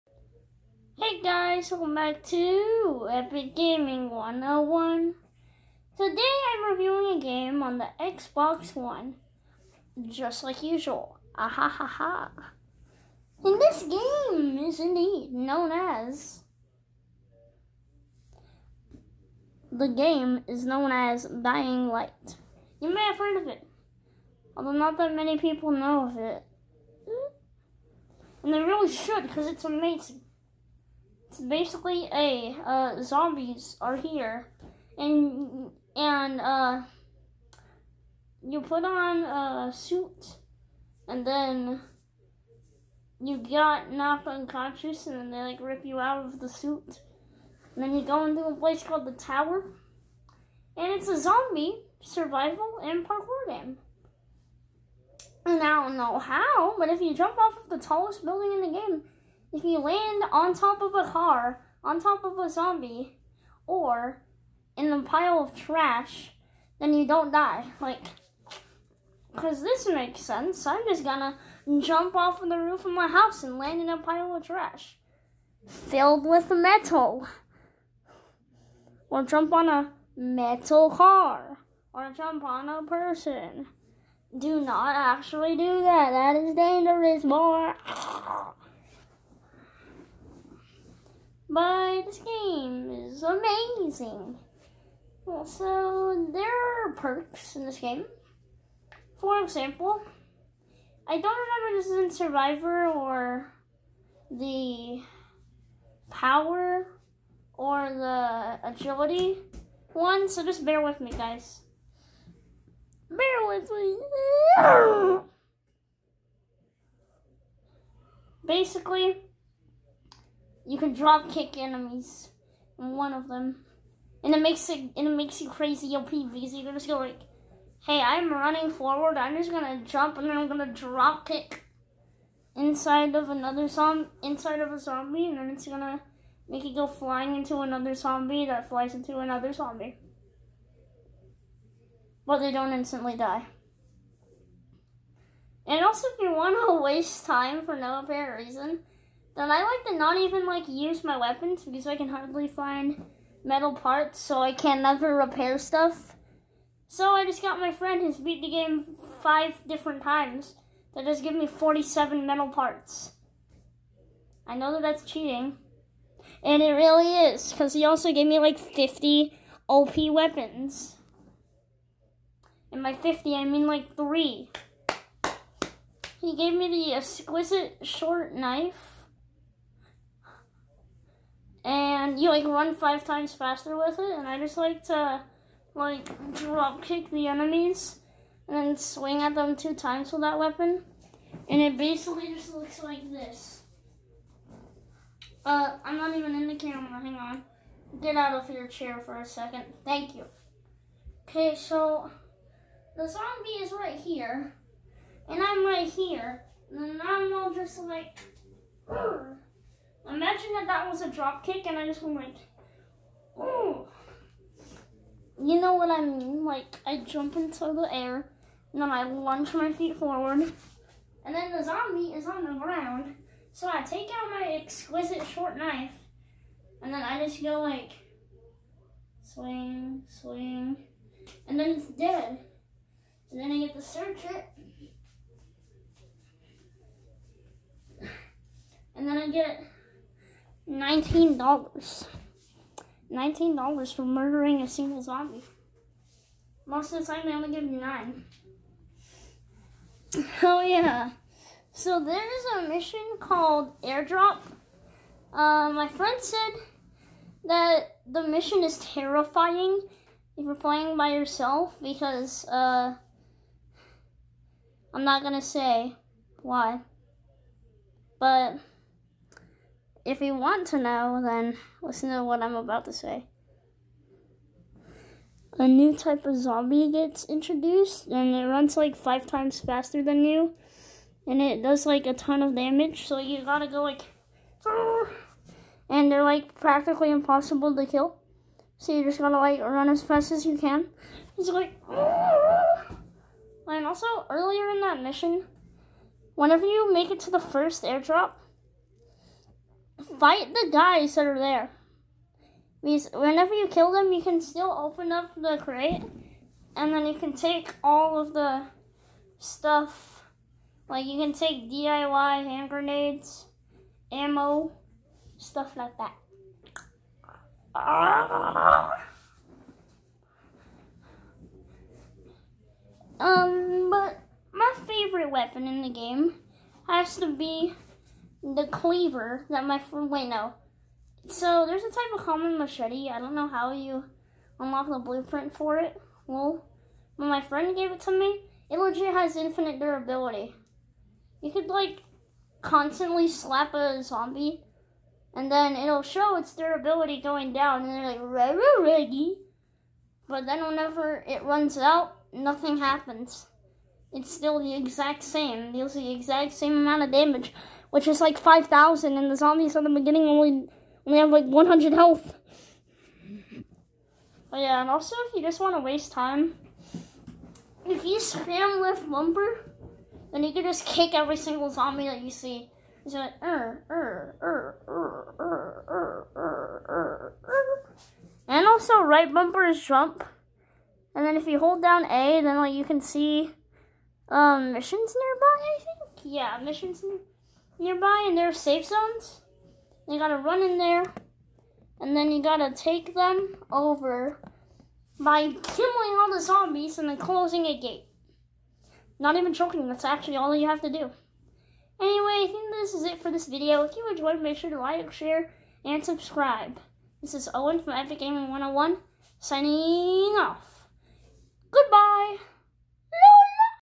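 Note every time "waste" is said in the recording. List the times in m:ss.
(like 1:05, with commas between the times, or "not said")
2:26, 6:05.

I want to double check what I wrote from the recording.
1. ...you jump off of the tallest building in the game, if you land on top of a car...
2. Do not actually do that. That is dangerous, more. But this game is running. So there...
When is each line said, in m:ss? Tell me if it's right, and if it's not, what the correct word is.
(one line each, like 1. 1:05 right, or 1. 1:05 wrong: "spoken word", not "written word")
1. 0:56 right
2. 1:24 wrong: "amazing", not "running".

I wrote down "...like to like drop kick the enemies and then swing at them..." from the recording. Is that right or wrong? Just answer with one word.
right.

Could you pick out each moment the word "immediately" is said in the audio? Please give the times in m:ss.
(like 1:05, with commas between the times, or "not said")
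not said.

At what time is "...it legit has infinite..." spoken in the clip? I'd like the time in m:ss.
5:38.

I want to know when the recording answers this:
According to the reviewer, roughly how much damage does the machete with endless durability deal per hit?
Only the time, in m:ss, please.
5:58.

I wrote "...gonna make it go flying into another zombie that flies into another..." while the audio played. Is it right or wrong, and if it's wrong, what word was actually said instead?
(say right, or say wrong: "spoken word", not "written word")
right.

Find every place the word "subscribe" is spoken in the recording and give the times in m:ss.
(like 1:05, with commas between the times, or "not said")
6:46.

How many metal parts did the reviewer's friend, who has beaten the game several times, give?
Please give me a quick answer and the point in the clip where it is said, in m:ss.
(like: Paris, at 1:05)
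47, at 2:41.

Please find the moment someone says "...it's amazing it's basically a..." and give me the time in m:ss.
0:29.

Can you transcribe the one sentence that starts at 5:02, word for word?
Because whenever you kill them, you can still open up the crate, and then you can take all of the stuff.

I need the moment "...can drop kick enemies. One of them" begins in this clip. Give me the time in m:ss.
2:00.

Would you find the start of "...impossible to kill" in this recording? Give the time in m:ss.
4:47.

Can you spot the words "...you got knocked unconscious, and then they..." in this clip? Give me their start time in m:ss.
0:43.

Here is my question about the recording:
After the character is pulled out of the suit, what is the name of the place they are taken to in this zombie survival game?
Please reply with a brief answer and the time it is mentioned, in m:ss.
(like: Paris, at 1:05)
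the Tower, at 0:49.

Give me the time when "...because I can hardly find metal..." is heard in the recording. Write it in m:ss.
2:31.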